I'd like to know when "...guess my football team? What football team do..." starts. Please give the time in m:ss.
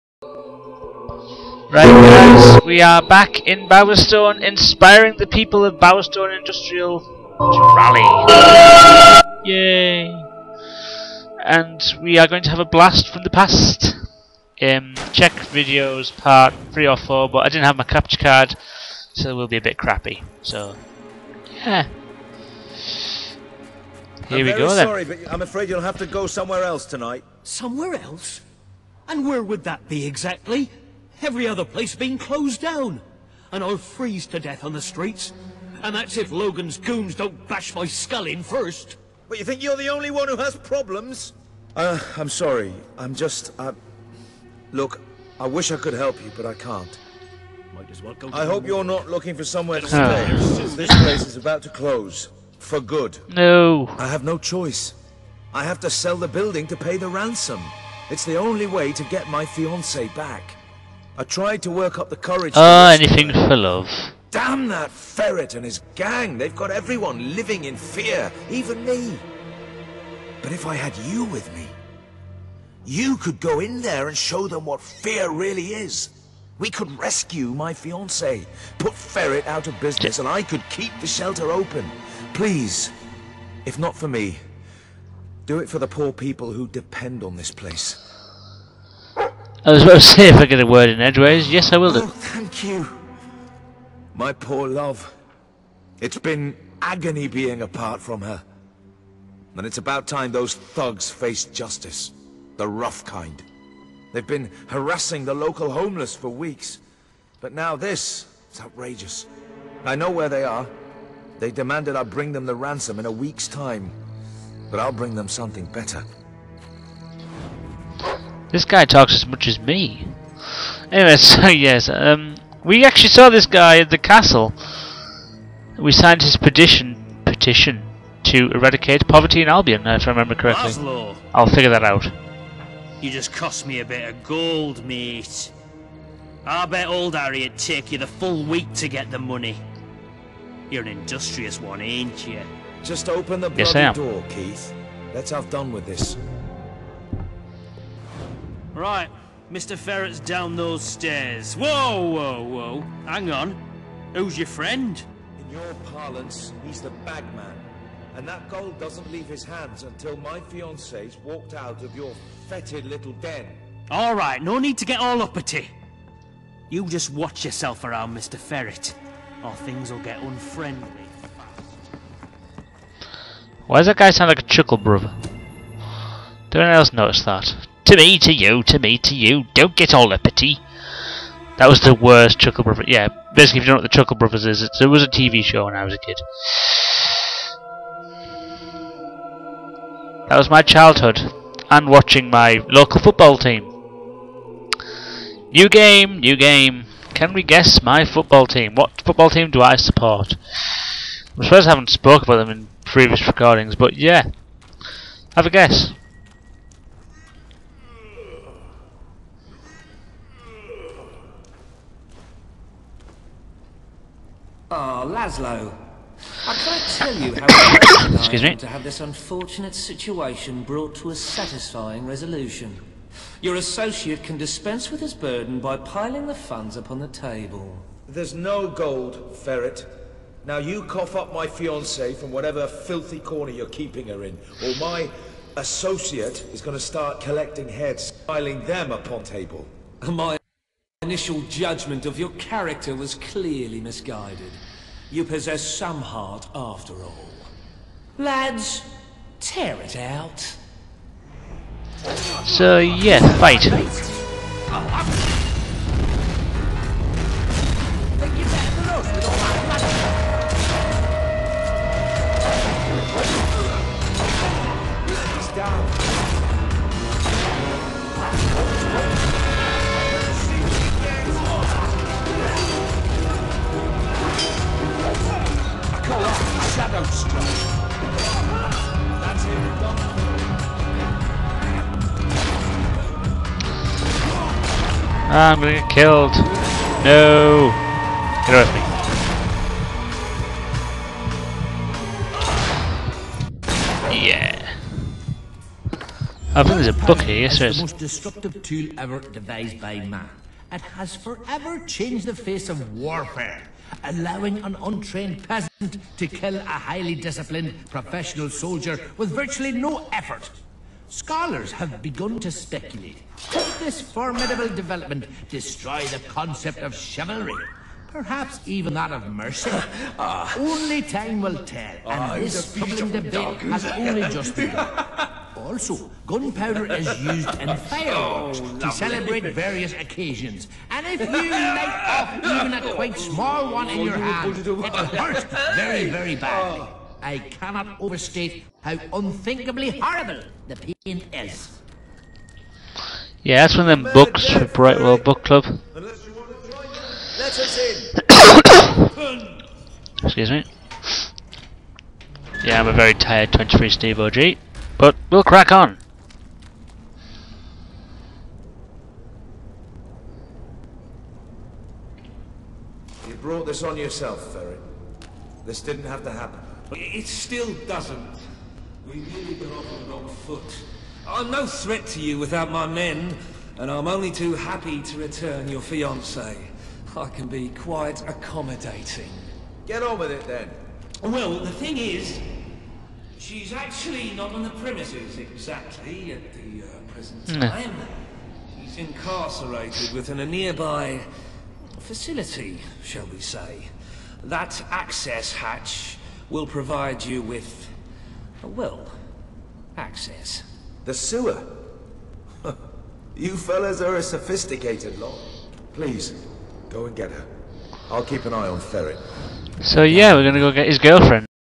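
3:17.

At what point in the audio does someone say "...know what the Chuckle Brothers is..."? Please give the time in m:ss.
3:03.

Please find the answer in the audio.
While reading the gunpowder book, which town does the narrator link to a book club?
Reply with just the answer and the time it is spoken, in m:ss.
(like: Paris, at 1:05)
Brightwall, at 5:44.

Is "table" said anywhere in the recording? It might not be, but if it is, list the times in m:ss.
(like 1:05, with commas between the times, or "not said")
3:47, 3:59.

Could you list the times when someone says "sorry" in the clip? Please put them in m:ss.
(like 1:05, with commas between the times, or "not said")
0:24, 0:42.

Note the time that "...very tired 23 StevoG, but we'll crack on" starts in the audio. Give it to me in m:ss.
5:52.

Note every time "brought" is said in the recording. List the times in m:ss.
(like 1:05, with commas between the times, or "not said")
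3:40, 6:03.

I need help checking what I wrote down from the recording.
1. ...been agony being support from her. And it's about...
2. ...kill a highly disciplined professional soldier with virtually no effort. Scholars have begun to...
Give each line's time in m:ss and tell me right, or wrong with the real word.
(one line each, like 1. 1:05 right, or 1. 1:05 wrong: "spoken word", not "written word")
1. 1:36 wrong: "apart", not "support"
2. 5:06 right.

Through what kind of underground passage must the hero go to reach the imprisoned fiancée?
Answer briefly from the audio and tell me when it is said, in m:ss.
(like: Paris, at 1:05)
the sewer, at 6:41.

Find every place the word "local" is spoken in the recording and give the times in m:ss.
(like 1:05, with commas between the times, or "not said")
1:45, 3:12.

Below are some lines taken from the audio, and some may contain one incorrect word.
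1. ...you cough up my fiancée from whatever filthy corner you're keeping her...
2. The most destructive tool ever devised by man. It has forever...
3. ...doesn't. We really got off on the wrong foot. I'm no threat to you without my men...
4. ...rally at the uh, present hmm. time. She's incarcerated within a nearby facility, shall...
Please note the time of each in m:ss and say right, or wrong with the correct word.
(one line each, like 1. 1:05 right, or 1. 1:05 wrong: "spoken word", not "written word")
1. 3:50 right
2. 4:57 right
3. 6:07 right
4. 6:25 wrong: "exactly", not "rally".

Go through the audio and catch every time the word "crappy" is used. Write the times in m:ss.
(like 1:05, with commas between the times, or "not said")
0:19.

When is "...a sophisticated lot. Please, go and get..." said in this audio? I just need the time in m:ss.
6:44.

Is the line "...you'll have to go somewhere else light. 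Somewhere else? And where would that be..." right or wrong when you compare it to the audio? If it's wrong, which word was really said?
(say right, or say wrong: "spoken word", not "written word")
wrong: "tonight", not "light".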